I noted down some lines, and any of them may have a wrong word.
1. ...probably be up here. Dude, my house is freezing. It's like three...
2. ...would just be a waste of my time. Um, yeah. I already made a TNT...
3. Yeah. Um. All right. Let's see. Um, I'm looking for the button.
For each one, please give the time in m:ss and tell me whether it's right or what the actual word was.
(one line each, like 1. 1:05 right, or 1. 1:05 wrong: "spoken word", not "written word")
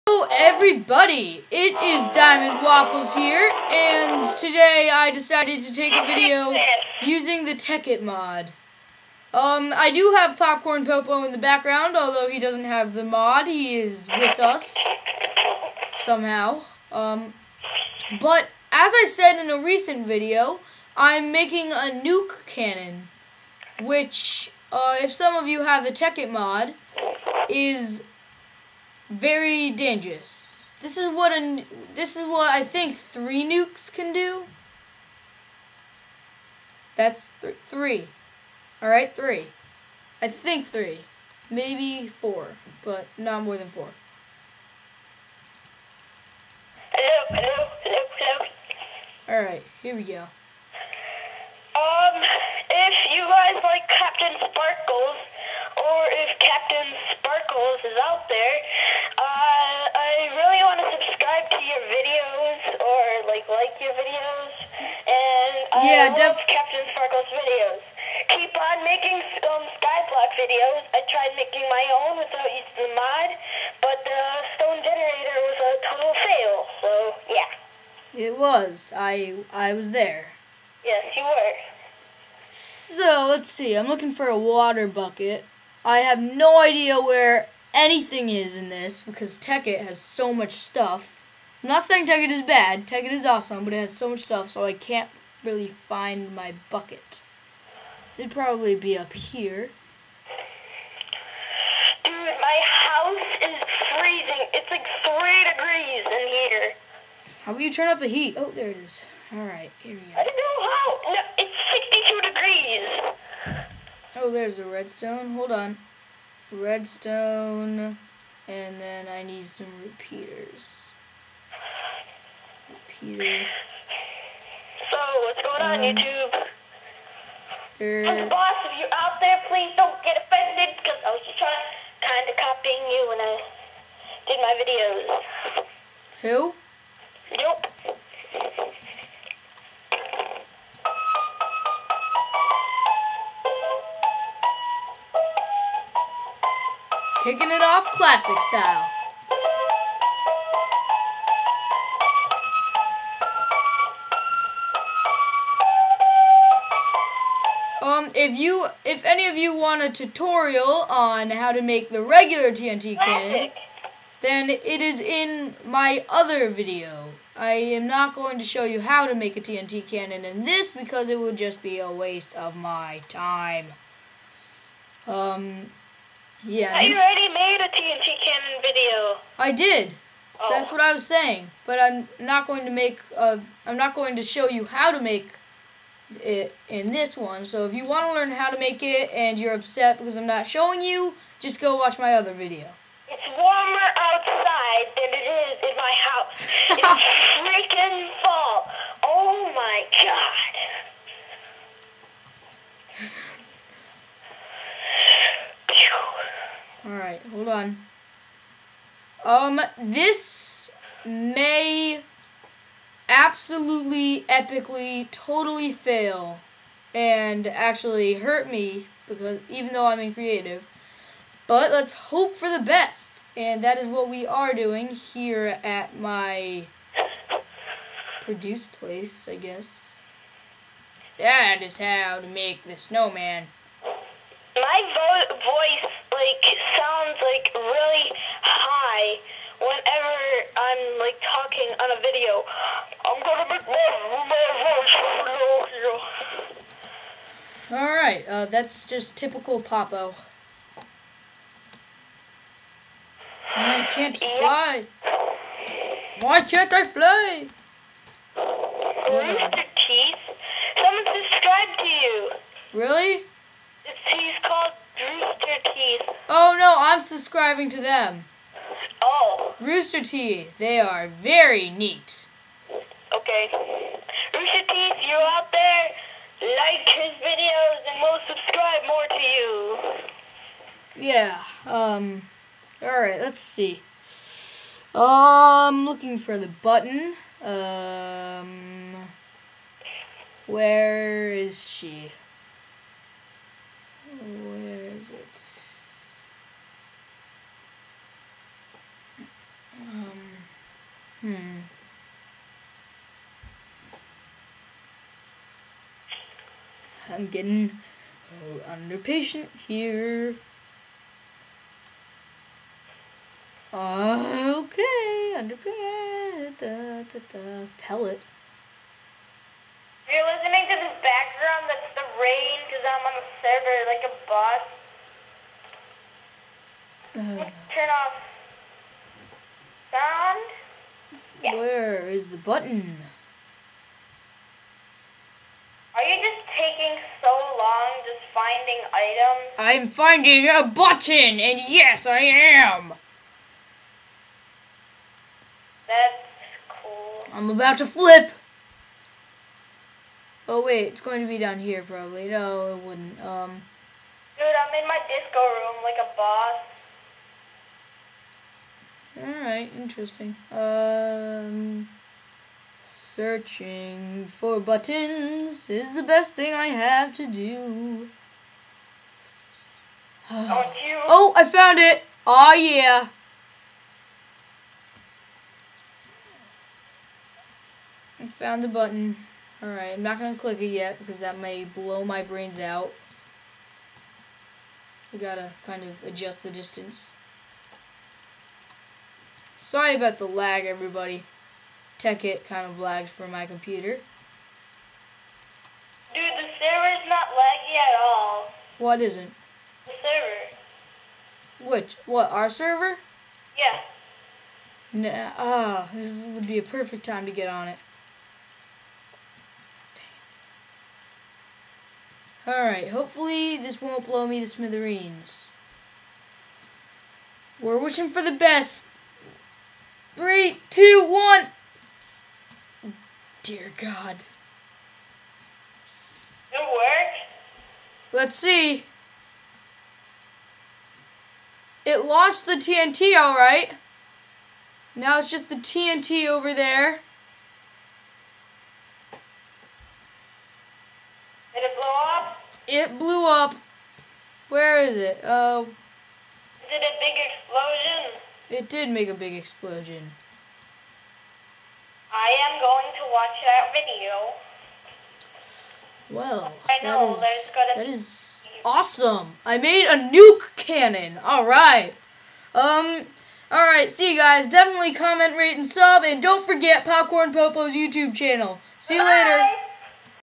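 1. 1:38 right
2. 2:51 right
3. 4:41 right.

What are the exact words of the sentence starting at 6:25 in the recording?
We gotta kind of adjust the distance.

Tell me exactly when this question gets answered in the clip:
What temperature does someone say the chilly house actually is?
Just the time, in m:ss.
1:53.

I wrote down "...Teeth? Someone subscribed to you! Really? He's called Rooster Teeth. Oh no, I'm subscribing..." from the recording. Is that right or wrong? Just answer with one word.
right.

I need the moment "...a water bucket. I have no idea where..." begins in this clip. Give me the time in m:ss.
1:24.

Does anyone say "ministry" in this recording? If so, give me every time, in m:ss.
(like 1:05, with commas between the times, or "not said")
not said.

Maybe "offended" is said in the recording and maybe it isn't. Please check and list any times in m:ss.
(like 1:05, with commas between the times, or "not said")
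2:10.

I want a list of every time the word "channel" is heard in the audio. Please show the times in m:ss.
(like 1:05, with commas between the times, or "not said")
7:48.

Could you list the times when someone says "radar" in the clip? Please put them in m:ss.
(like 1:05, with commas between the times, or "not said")
not said.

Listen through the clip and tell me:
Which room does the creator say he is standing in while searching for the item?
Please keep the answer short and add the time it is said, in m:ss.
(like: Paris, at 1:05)
disco room, at 5:55.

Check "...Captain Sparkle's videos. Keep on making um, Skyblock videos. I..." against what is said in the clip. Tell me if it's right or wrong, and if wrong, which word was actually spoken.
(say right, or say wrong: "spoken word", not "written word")
right.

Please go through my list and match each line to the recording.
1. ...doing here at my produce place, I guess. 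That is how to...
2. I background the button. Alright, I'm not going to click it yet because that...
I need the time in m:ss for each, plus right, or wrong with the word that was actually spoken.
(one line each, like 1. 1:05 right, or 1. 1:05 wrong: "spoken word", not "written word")
1. 3:44 right
2. 6:18 wrong: "found", not "background".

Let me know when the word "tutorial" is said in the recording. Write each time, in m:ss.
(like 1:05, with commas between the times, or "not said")
2:39.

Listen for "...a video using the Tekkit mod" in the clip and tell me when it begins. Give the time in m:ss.
0:05.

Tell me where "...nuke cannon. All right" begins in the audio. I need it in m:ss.
7:40.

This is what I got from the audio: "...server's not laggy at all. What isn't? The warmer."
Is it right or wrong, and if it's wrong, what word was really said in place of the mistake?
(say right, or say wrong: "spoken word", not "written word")
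wrong: "server", not "warmer".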